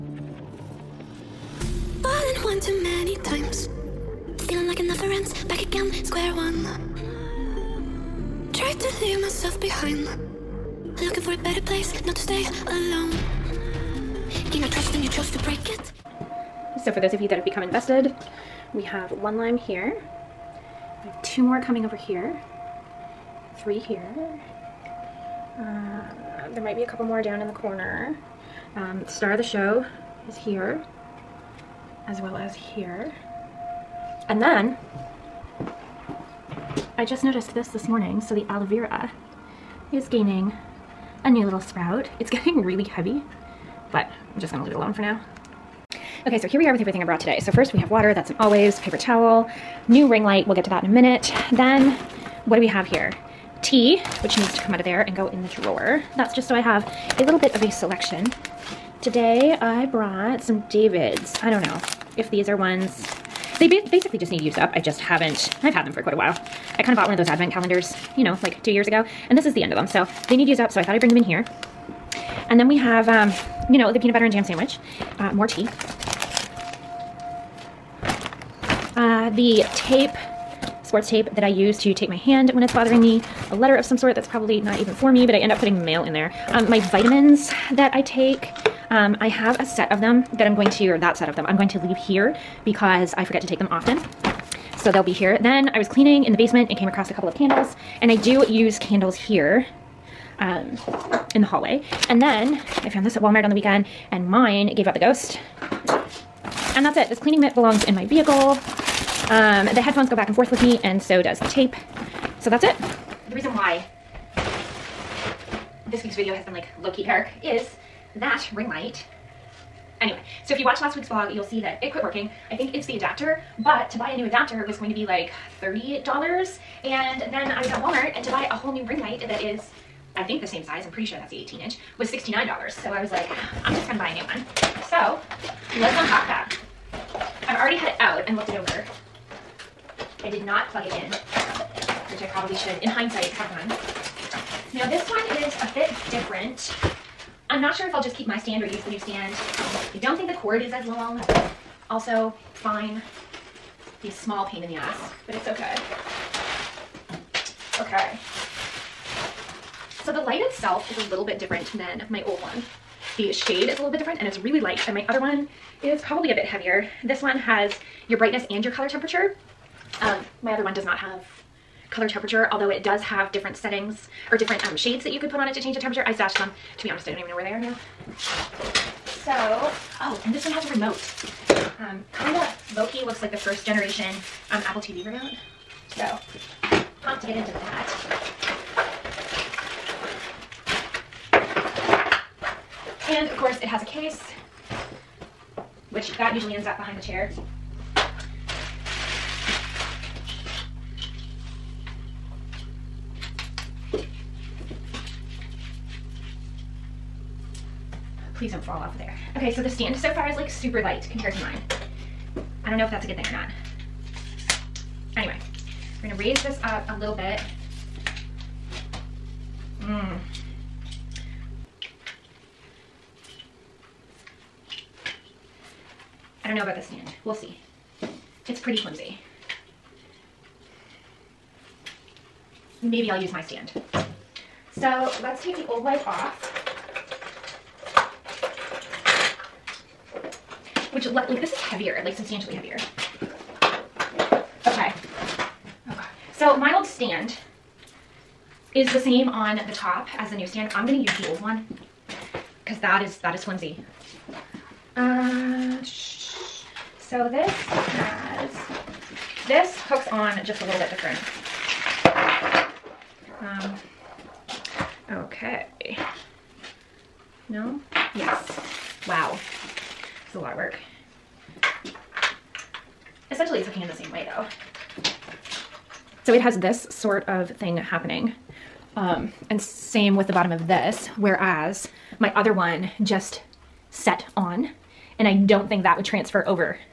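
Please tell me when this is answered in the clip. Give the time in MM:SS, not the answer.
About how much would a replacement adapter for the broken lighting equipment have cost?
02:05.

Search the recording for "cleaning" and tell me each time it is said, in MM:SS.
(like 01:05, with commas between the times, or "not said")
01:35, 01:47.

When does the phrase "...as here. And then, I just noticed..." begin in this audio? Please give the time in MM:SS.
00:32.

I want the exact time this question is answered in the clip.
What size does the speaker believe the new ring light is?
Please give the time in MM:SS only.
02:11.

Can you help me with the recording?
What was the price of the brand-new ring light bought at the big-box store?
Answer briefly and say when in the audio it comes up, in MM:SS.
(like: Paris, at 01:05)
$69, at 02:12.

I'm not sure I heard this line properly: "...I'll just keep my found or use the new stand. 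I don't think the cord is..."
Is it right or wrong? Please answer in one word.
wrong.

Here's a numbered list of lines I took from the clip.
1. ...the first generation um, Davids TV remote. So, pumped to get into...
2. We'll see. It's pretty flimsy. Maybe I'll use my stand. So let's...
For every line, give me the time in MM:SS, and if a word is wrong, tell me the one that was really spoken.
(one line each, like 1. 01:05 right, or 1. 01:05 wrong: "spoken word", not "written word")
1. 03:03 wrong: "Apple", not "Davids"
2. 03:47 right.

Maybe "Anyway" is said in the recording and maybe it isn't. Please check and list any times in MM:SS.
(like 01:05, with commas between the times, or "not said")
02:00, 03:35.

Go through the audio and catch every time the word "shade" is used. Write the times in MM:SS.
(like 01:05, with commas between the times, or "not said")
02:43, 02:54.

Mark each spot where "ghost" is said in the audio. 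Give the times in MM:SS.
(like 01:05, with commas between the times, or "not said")
01:44.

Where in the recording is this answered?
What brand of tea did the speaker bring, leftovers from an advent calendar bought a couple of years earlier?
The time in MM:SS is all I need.
01:00.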